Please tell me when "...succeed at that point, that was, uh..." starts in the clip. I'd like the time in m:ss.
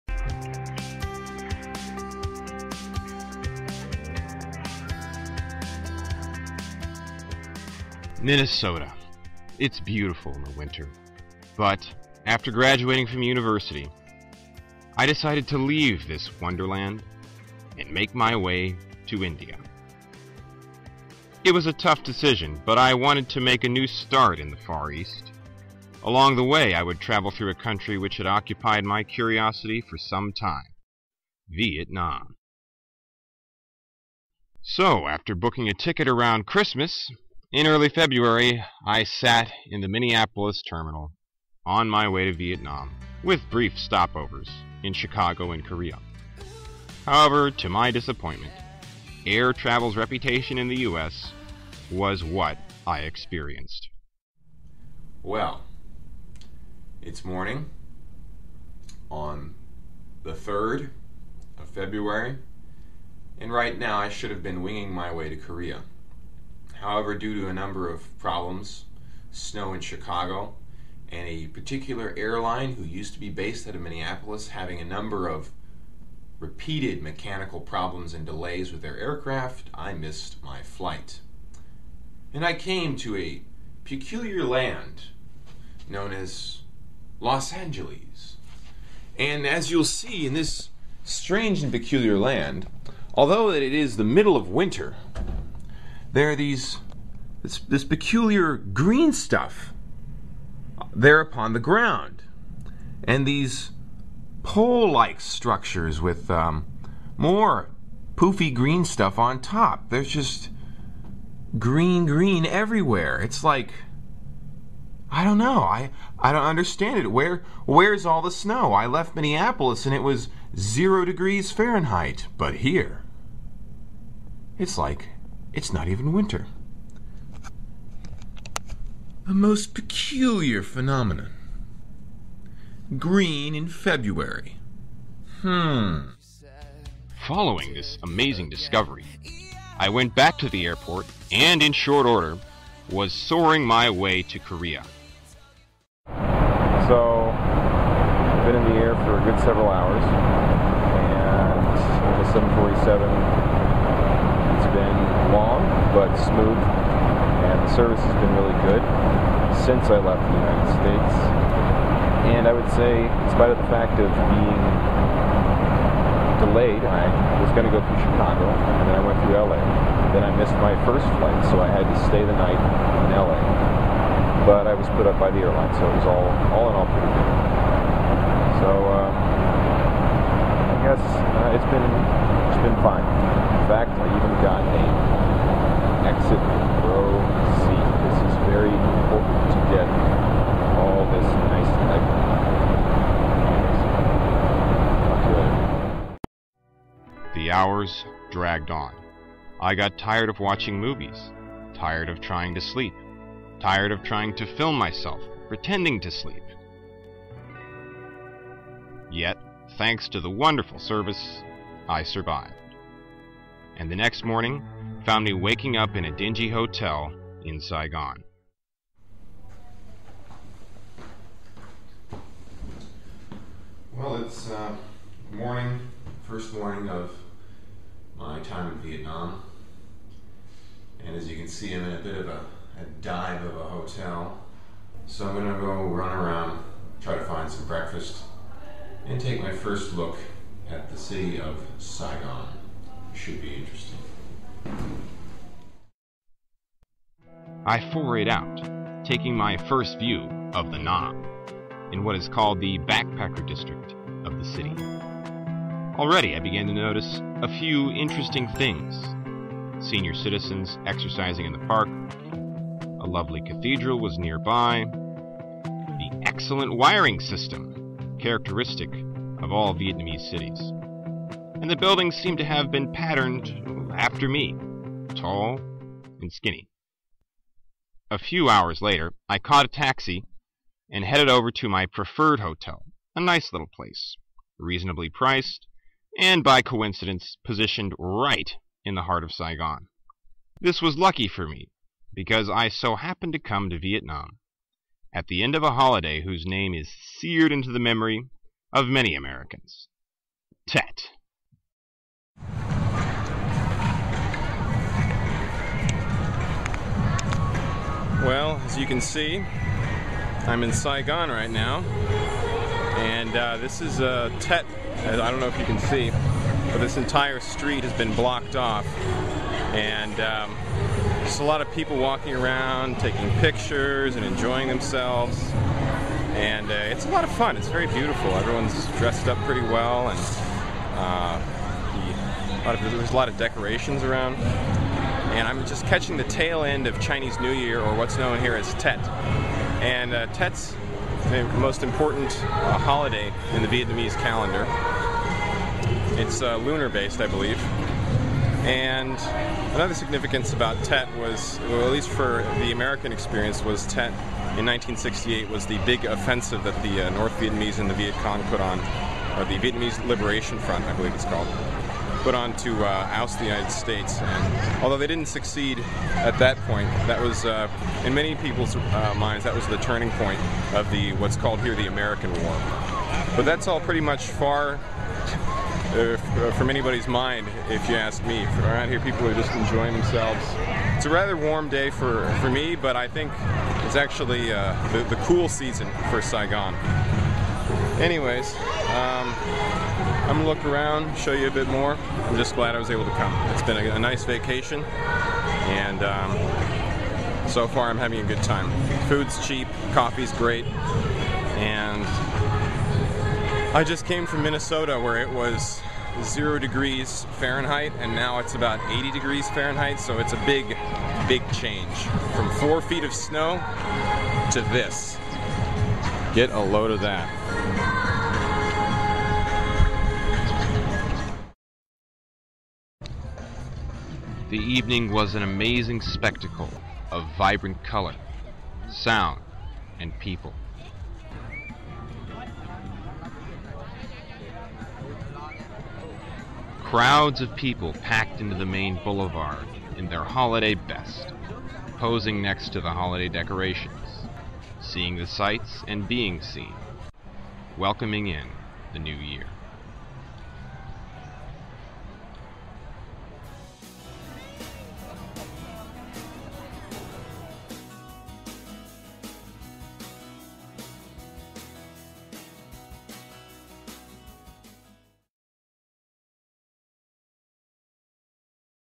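6:05.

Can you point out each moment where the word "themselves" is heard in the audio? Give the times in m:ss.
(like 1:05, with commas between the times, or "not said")
5:24, 6:19.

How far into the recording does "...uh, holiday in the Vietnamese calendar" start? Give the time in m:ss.
5:42.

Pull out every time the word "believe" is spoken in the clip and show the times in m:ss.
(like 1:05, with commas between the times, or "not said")
5:47, 6:00.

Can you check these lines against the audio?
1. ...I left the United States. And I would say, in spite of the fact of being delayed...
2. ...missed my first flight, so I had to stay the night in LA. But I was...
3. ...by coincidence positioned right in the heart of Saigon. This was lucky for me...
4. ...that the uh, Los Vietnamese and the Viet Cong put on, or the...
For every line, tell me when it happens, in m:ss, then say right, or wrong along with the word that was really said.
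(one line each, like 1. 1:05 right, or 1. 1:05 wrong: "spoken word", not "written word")
1. 2:39 right
2. 2:50 right
3. 4:46 right
4. 5:56 wrong: "North", not "Los".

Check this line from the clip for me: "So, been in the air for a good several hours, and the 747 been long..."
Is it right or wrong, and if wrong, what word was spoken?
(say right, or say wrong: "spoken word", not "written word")
right.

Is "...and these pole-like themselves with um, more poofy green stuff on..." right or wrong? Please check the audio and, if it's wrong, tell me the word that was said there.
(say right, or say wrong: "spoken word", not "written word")
wrong: "structures", not "themselves".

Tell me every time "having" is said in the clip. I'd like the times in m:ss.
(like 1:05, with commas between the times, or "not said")
1:14, 6:37.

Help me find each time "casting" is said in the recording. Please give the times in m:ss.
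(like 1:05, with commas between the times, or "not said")
not said.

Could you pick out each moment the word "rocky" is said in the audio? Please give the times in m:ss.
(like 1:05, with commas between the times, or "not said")
not said.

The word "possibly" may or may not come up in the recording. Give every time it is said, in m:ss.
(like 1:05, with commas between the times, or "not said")
not said.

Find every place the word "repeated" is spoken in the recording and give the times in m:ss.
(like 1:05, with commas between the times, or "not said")
1:16.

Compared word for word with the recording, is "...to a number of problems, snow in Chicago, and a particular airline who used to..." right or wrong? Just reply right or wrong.
right.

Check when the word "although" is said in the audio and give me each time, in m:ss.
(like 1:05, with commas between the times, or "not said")
1:33, 6:04.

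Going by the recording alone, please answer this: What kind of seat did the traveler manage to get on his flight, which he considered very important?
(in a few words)
Exit row seat.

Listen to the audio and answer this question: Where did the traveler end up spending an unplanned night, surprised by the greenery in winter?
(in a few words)
Los Angeles.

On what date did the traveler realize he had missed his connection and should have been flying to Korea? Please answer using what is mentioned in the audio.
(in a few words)
February 3.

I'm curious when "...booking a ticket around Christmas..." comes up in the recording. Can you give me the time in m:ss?
0:35.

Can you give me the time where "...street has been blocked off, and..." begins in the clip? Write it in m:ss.
5:17.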